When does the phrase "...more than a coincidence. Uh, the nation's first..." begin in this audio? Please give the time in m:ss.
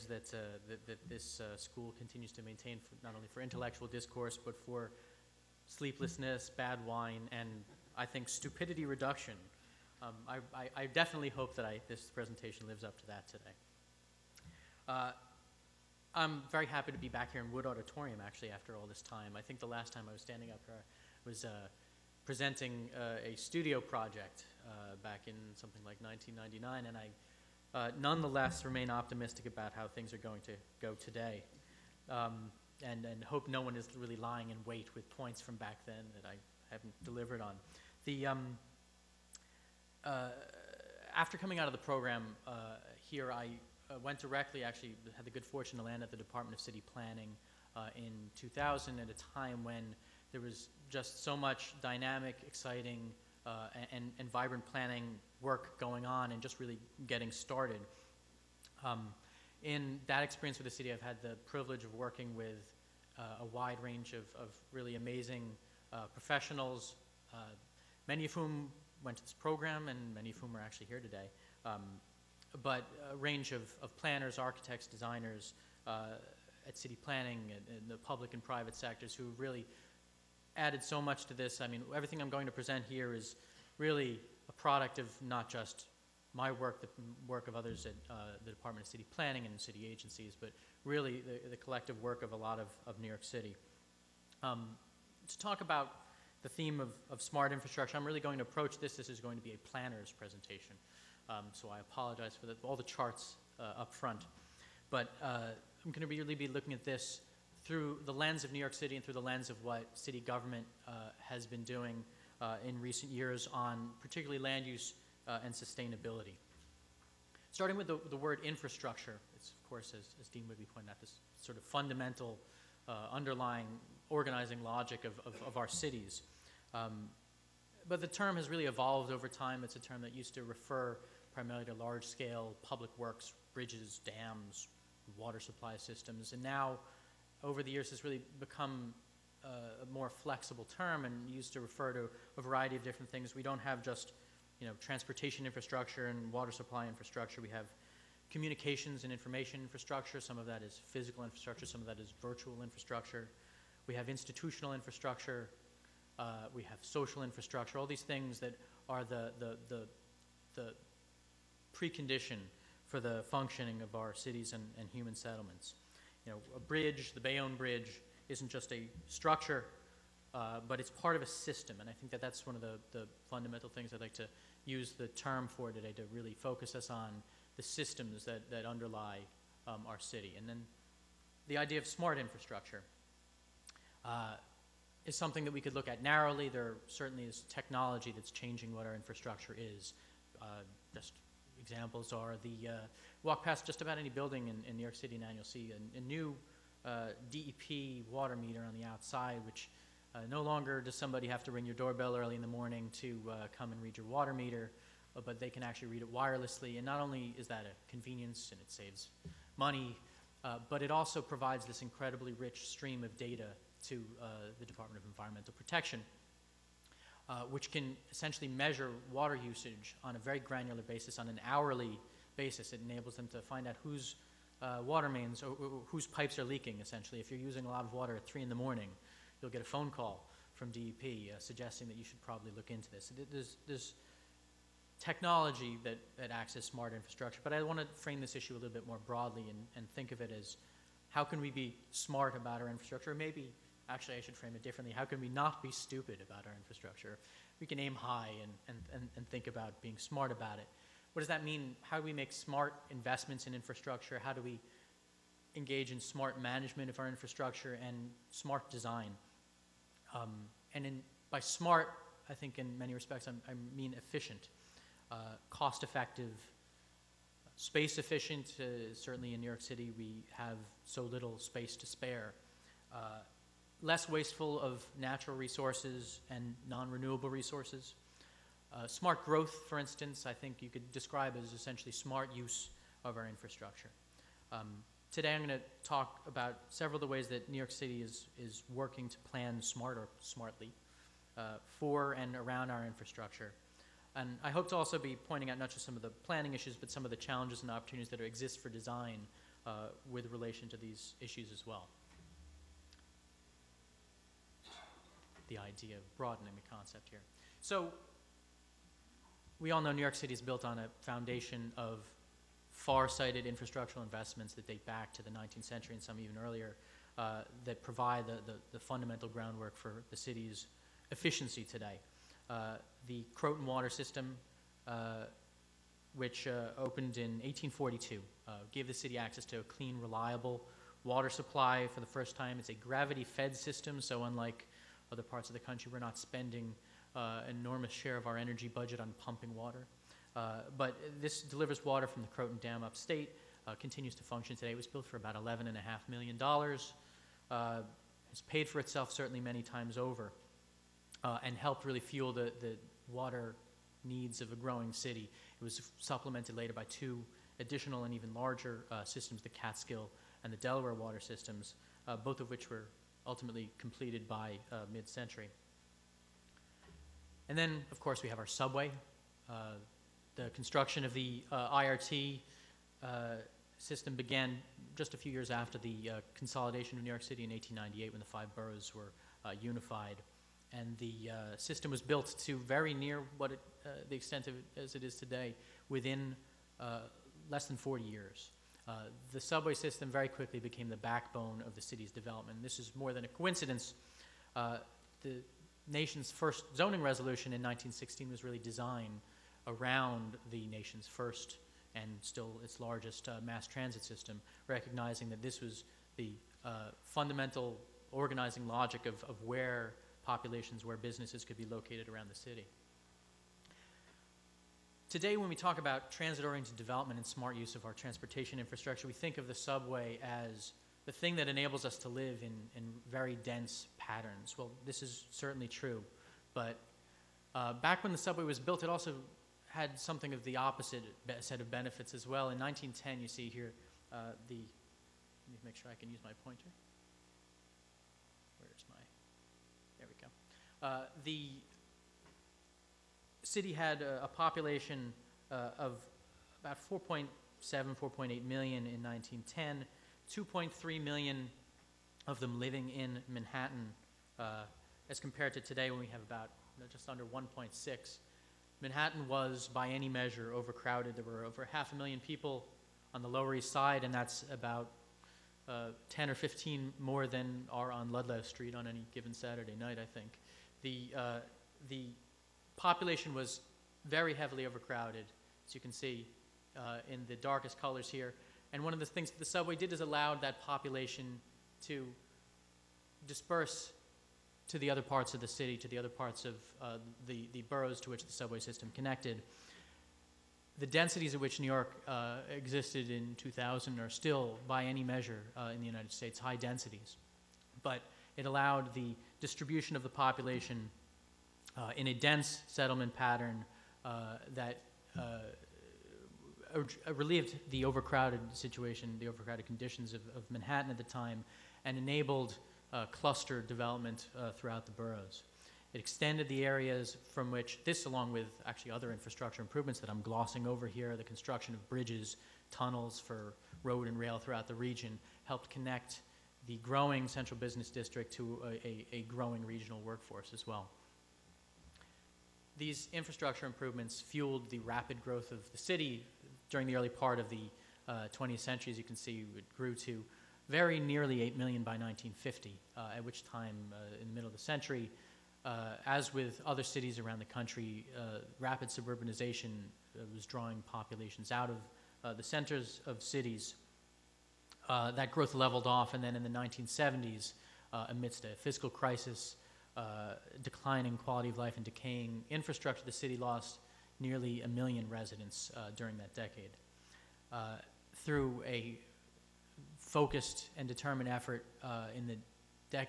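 6:32.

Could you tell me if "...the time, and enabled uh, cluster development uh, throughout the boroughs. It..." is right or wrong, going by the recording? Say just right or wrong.
right.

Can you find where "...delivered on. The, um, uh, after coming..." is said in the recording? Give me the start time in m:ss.
0:37.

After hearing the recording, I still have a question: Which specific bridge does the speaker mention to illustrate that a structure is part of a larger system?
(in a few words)
Bayonne Bridge.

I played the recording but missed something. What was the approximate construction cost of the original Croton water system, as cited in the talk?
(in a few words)
$11.5 million.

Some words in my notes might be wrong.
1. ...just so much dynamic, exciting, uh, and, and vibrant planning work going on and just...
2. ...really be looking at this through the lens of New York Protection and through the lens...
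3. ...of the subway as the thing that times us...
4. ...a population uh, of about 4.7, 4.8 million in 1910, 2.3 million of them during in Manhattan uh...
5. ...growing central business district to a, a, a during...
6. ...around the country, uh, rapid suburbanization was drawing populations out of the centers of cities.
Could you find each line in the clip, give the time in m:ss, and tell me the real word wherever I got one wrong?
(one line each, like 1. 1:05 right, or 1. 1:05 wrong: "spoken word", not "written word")
1. 0:50 right
2. 1:46 wrong: "City", not "Protection"
3. 6:59 wrong: "enables", not "times"
4. 7:24 wrong: "living", not "during"
5. 8:46 wrong: "growing", not "during"
6. 9:07 right.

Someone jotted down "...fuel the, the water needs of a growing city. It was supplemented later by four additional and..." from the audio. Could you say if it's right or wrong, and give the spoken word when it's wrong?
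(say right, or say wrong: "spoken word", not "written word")
wrong: "two", not "four".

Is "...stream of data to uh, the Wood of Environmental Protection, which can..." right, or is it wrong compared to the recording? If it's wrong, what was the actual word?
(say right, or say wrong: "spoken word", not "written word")
wrong: "Department", not "Wood".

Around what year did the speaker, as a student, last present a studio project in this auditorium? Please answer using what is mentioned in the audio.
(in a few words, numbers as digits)
1999.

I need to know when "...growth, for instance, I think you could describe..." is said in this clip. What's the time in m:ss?
4:39.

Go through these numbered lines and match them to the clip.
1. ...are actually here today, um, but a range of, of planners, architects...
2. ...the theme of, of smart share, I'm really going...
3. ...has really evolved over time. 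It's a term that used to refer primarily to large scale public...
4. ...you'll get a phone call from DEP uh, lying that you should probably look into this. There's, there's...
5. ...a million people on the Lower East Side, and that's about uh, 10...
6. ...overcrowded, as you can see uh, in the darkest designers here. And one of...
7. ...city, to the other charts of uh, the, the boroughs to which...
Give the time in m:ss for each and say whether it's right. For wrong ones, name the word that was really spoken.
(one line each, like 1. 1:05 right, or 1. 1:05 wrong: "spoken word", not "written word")
1. 1:10 right
2. 1:36 wrong: "infrastructure", not "share"
3. 2:08 right
4. 3:49 wrong: "suggesting", not "lying"
5. 7:41 right
6. 7:54 wrong: "colors", not "designers"
7. 8:05 wrong: "parts", not "charts".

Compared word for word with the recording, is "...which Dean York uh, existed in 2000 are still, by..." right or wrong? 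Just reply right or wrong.
wrong.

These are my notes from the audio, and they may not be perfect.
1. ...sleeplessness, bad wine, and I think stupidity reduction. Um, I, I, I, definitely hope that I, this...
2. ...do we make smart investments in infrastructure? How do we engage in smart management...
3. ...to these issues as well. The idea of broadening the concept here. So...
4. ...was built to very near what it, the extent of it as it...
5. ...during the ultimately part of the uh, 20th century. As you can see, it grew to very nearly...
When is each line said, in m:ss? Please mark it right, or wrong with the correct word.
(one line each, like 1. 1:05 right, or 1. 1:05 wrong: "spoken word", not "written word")
1. 0:05 right
2. 4:11 right
3. 5:00 right
4. 6:21 right
5. 8:56 wrong: "early", not "ultimately".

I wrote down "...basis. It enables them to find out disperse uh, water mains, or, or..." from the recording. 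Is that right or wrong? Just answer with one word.
wrong.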